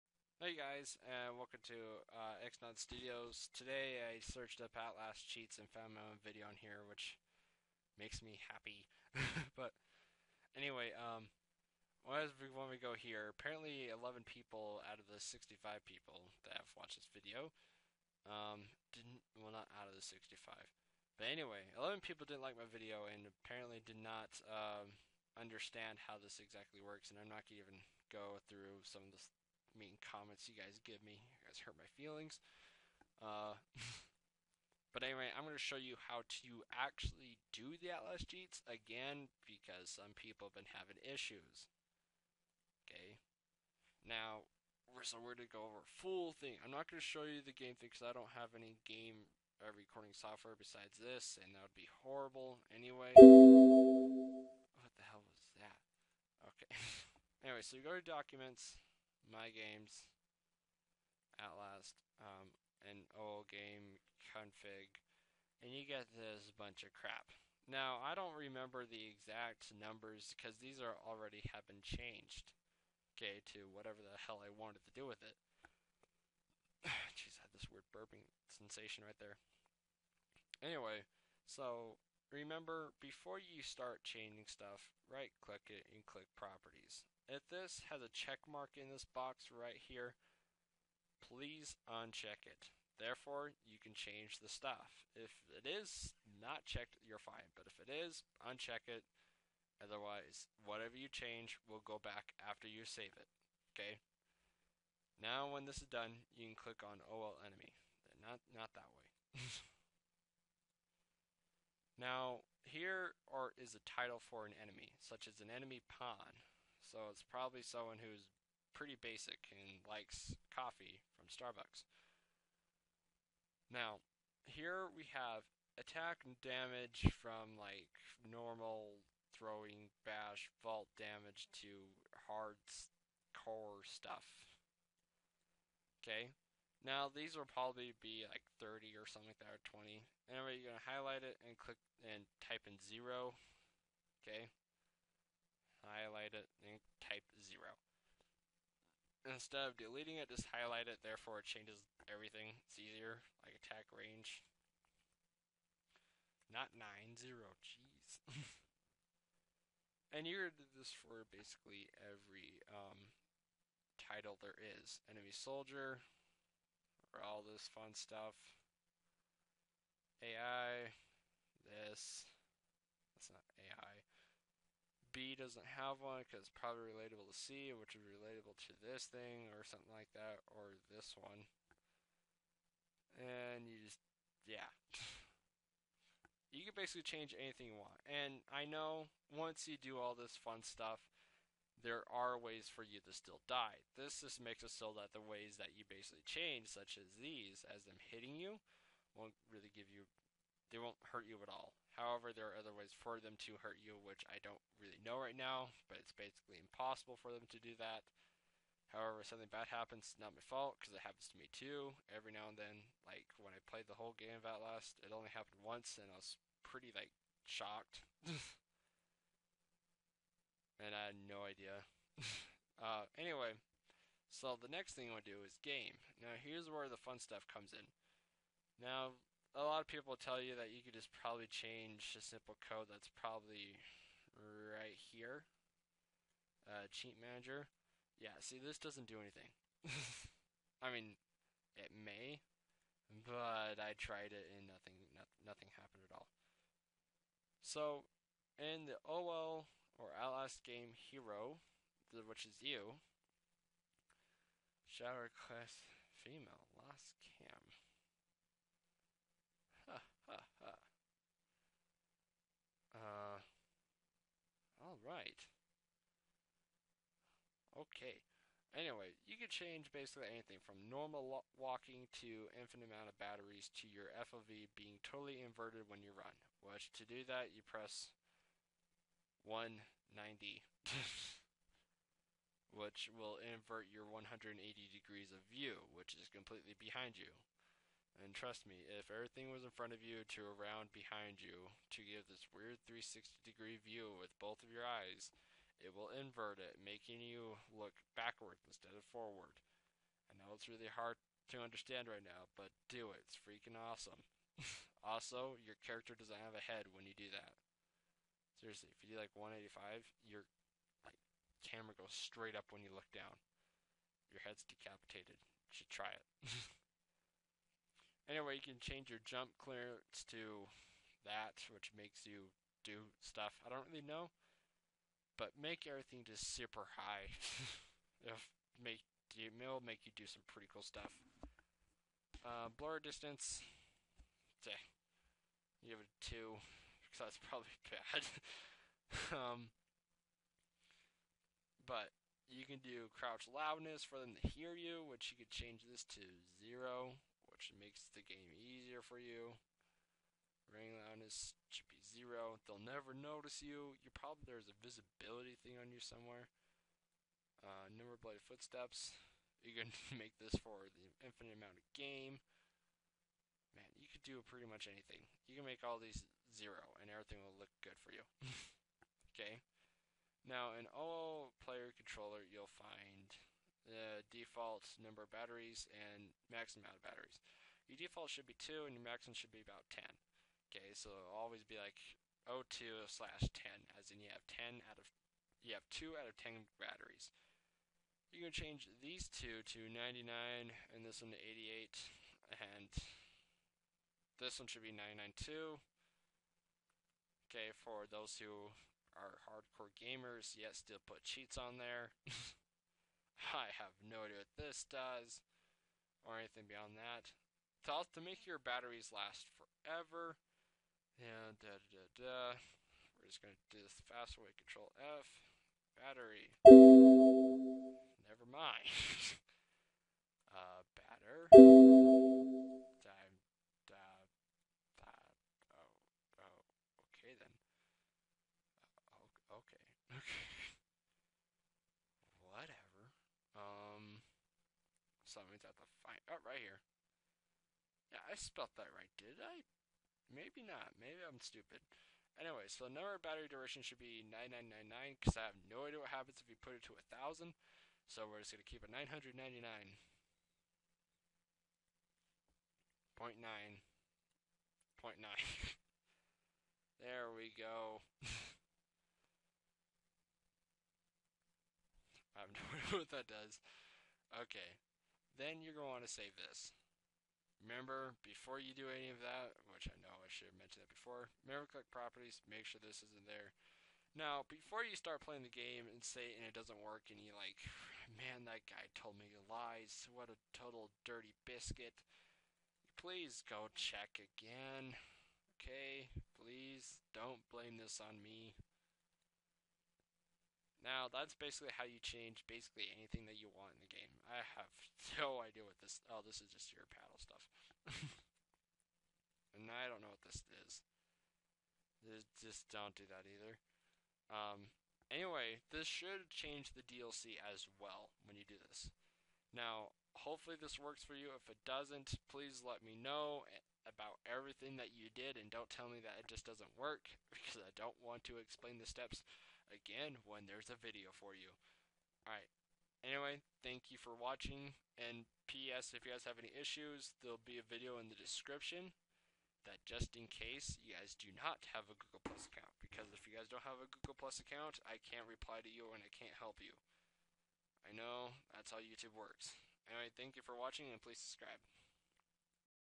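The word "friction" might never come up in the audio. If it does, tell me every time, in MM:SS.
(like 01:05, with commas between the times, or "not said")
not said.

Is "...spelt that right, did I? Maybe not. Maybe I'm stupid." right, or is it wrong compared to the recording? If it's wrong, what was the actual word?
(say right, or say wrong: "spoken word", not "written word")
right.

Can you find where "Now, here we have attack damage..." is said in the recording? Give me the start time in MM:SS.
02:03.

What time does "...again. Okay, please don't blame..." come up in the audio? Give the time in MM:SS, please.
08:04.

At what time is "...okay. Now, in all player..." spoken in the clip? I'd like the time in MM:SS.
06:09.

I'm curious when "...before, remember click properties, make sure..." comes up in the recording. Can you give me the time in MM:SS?
07:50.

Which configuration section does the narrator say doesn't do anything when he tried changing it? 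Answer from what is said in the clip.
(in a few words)
Cheat manager.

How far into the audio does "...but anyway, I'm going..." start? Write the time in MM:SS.
00:34.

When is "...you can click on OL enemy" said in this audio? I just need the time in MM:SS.
01:46.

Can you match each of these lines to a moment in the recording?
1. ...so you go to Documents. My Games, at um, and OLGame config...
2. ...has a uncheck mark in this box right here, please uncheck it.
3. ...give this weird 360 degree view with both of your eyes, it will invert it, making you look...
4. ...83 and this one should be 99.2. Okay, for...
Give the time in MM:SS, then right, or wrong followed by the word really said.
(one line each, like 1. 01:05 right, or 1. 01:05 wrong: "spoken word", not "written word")
1. 00:57 right
2. 01:27 wrong: "check", not "uncheck"
3. 04:52 right
4. 06:31 wrong: "88", not "83".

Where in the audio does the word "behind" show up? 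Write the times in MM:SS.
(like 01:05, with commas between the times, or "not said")
04:46, 04:50.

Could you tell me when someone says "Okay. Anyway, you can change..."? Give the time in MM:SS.
04:27.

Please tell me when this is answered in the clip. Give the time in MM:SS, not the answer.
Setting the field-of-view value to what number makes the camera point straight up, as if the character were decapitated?
05:09.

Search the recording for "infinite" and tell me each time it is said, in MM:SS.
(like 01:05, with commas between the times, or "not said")
04:32, 06:01.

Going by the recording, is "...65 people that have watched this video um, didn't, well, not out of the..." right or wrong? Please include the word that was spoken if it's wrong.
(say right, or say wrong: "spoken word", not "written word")
right.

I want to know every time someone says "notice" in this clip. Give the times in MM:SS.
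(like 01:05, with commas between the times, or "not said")
05:53.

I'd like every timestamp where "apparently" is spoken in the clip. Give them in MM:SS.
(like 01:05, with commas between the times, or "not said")
00:13, 00:23.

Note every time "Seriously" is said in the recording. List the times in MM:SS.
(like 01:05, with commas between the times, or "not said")
05:08.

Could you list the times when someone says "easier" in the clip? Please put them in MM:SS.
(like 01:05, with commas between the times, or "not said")
02:32, 05:48.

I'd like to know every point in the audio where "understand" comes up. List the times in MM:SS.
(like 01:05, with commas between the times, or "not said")
00:25, 05:01.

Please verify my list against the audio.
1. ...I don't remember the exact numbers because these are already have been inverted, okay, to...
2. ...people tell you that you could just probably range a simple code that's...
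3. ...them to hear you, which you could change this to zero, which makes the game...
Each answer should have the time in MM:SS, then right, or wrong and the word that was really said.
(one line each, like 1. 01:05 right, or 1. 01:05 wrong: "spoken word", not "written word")
1. 01:08 wrong: "changed", not "inverted"
2. 03:49 wrong: "change", not "range"
3. 05:44 right.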